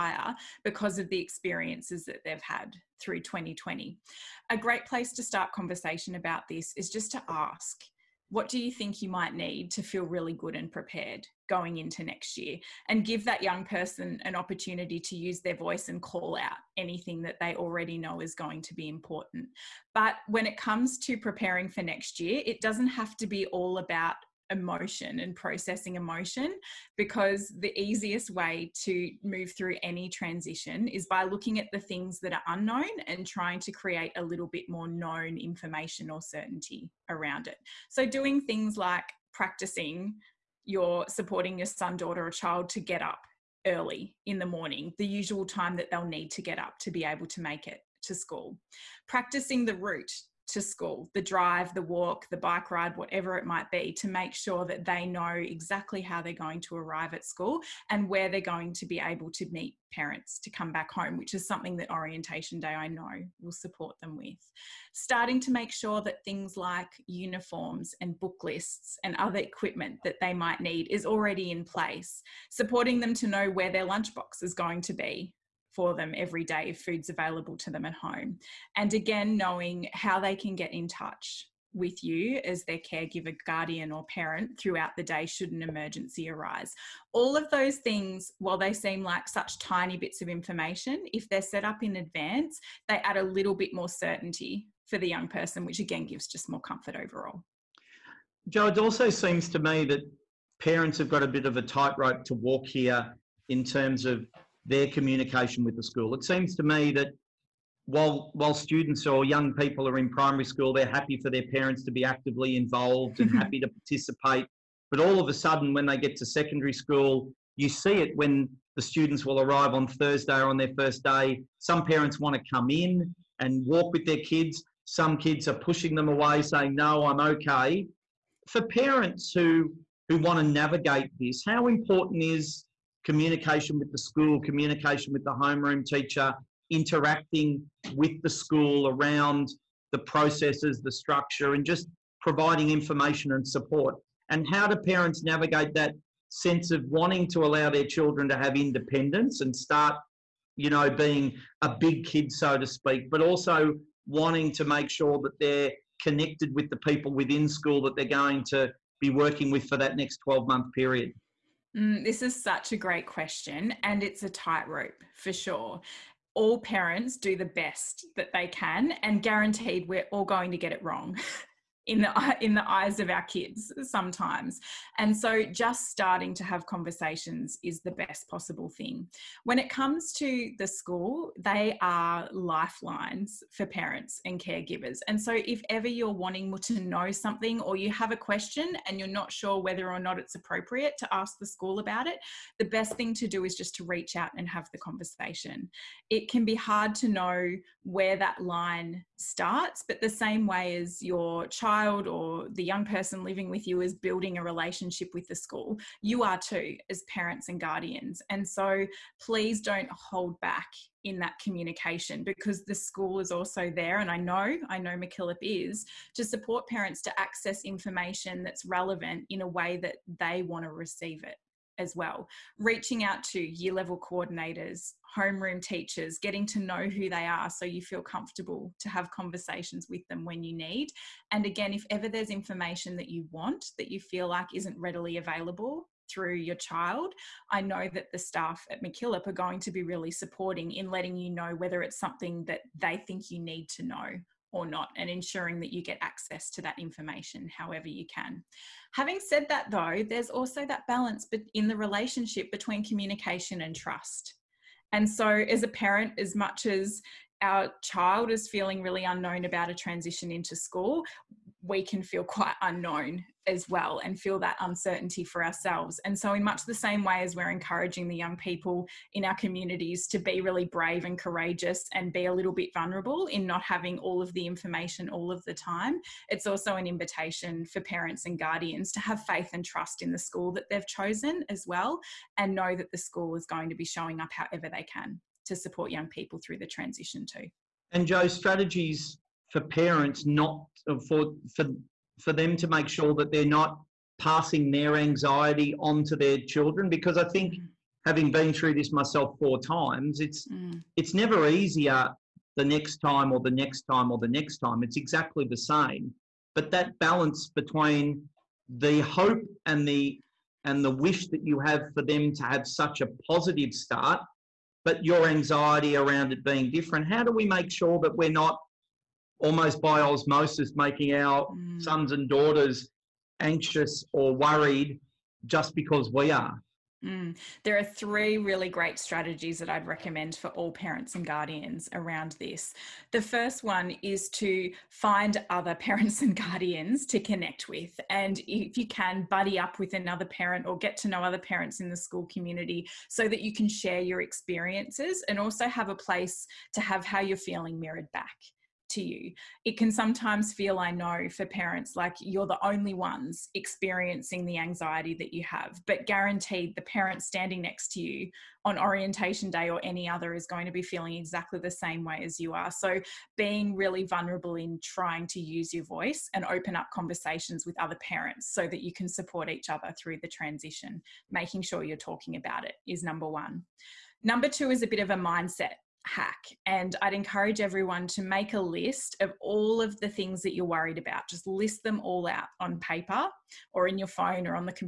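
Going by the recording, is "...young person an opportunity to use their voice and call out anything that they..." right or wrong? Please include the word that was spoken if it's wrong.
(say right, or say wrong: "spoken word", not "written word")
right.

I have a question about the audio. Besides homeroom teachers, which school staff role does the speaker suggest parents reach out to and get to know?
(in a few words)
year level coordinators.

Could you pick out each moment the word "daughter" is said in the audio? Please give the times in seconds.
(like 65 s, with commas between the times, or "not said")
41 s, 322 s.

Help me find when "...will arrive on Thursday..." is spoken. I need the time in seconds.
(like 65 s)
119 s.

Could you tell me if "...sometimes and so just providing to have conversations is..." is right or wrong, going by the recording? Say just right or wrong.
wrong.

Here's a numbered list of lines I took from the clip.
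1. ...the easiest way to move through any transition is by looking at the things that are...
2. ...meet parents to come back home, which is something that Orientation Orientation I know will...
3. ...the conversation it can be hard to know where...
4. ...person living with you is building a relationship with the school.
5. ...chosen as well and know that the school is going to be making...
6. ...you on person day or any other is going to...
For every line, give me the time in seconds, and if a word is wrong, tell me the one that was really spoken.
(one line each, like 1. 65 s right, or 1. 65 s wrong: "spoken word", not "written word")
1. 27 s right
2. 59 s wrong: "Day", not "Orientation"
3. 194 s right
4. 202 s right
5. 280 s wrong: "showing", not "making"
6. 358 s wrong: "orientation", not "person".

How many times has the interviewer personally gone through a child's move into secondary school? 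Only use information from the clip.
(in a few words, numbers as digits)
4.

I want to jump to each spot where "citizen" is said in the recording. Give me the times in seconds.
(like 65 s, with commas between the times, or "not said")
not said.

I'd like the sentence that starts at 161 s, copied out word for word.
Mm, this is such a great question, and it's a tightrope for sure.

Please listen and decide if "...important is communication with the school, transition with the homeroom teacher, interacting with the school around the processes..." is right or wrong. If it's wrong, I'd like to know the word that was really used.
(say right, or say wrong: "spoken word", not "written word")
wrong: "communication", not "transition".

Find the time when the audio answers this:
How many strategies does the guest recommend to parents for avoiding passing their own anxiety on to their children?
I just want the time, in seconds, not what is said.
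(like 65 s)
327 s.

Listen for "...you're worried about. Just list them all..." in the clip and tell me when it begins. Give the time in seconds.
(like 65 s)
380 s.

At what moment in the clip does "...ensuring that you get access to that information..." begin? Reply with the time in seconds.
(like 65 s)
245 s.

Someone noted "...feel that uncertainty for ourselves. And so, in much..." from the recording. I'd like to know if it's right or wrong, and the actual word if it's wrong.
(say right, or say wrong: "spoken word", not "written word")
right.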